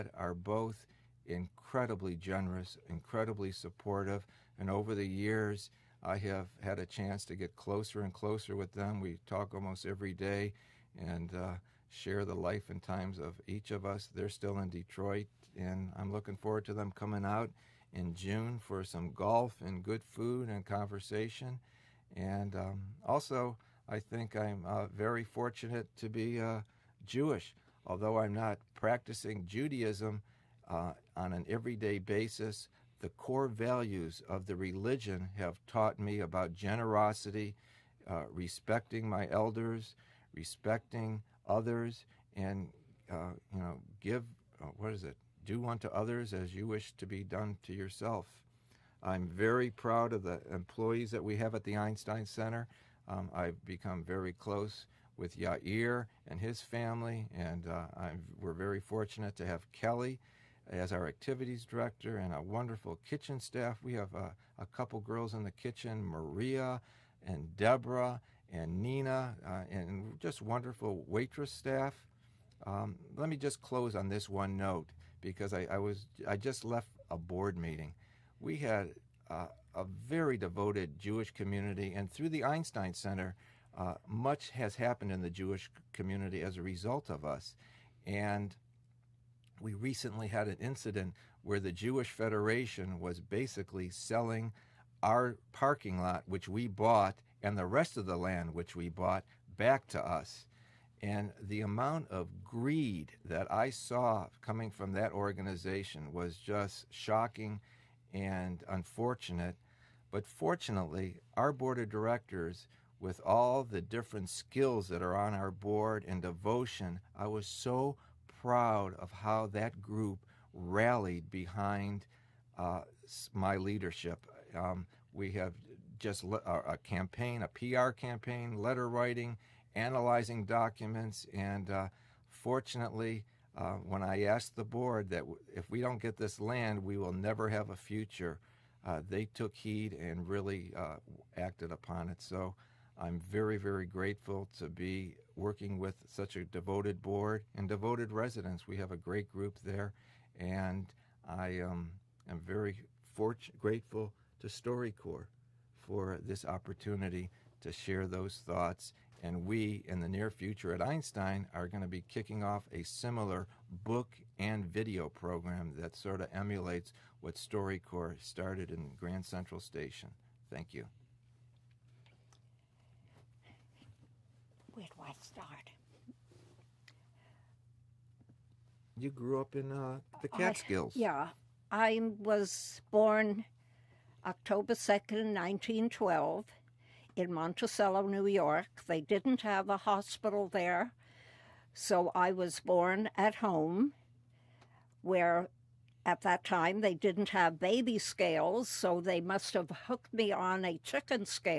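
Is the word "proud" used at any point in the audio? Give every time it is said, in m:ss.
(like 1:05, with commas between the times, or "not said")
0:49, 1:58.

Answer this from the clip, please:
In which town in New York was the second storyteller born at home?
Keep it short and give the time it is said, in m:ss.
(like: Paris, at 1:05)
Monticello, at 3:07.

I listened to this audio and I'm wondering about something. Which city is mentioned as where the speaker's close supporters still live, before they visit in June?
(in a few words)
Detroit.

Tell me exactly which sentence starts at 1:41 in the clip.
And the amount of greed that I saw coming from that organization was just shocking and unfortunate.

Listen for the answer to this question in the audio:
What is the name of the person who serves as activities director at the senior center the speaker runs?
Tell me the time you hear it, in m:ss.
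0:59.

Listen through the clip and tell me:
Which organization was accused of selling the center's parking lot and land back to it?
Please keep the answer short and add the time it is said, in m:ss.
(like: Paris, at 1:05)
Jewish Federation, at 1:31.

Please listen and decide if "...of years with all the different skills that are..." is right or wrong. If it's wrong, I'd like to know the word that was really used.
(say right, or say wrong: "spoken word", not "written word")
wrong: "directors", not "years".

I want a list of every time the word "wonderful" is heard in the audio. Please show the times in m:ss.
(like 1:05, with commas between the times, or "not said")
1:02, 1:10.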